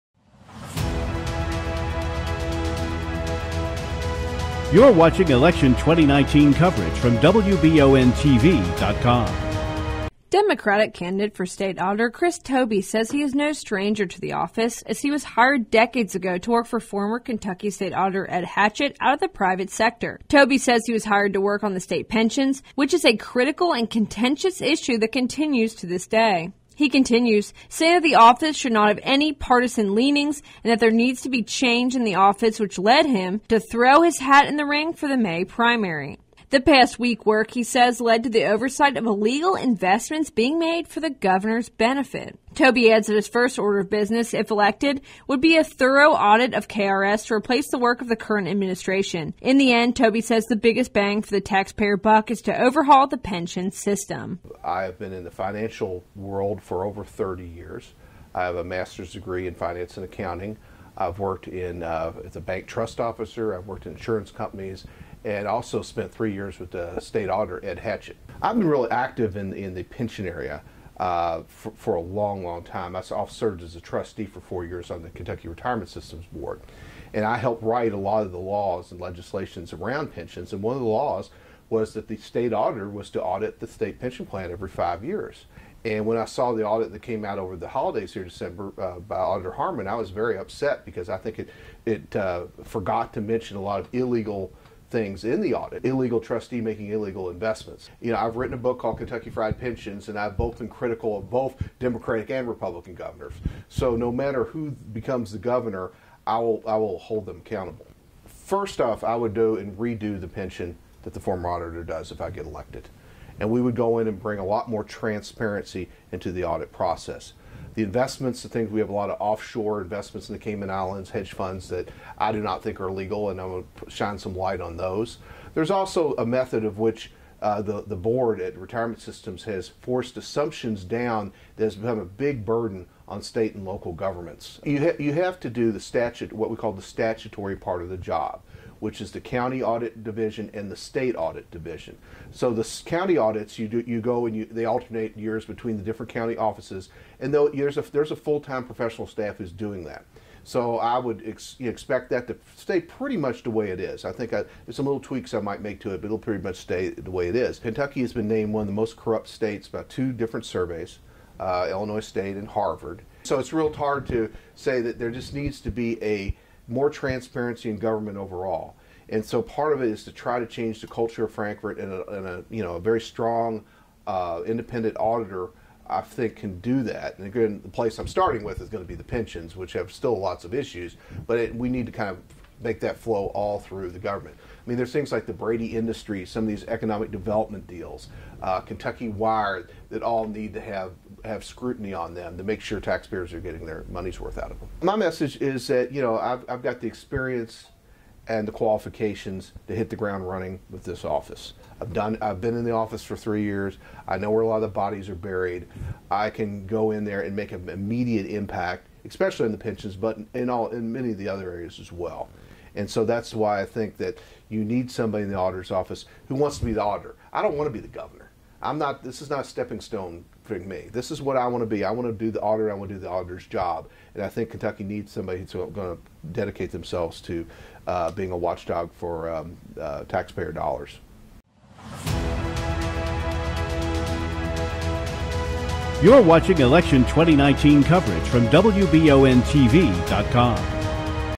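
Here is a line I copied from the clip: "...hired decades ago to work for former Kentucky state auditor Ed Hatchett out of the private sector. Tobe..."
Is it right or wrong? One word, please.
right.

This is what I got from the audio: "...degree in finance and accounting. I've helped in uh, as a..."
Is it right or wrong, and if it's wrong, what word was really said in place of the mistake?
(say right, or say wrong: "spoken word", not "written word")
wrong: "worked", not "helped".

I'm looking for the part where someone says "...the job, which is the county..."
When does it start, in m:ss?
2:17.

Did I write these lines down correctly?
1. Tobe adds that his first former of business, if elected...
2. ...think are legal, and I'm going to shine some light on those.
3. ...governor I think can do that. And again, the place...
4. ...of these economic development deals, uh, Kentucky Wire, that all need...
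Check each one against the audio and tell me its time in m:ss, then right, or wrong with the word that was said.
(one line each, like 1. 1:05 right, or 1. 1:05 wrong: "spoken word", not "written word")
1. 0:42 wrong: "order", not "former"
2. 2:02 right
3. 2:54 wrong: "auditor", not "governor"
4. 3:06 right.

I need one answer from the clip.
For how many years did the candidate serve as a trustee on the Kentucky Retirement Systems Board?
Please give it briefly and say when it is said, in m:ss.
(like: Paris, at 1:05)
4, at 1:14.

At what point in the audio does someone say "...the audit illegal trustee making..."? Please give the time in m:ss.
1:35.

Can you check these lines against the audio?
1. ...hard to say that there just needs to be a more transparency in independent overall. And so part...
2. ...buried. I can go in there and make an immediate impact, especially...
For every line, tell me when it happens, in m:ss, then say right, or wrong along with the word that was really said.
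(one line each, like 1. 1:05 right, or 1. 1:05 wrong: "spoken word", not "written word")
1. 2:43 wrong: "government", not "independent"
2. 3:25 right.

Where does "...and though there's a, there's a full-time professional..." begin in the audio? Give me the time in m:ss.
2:27.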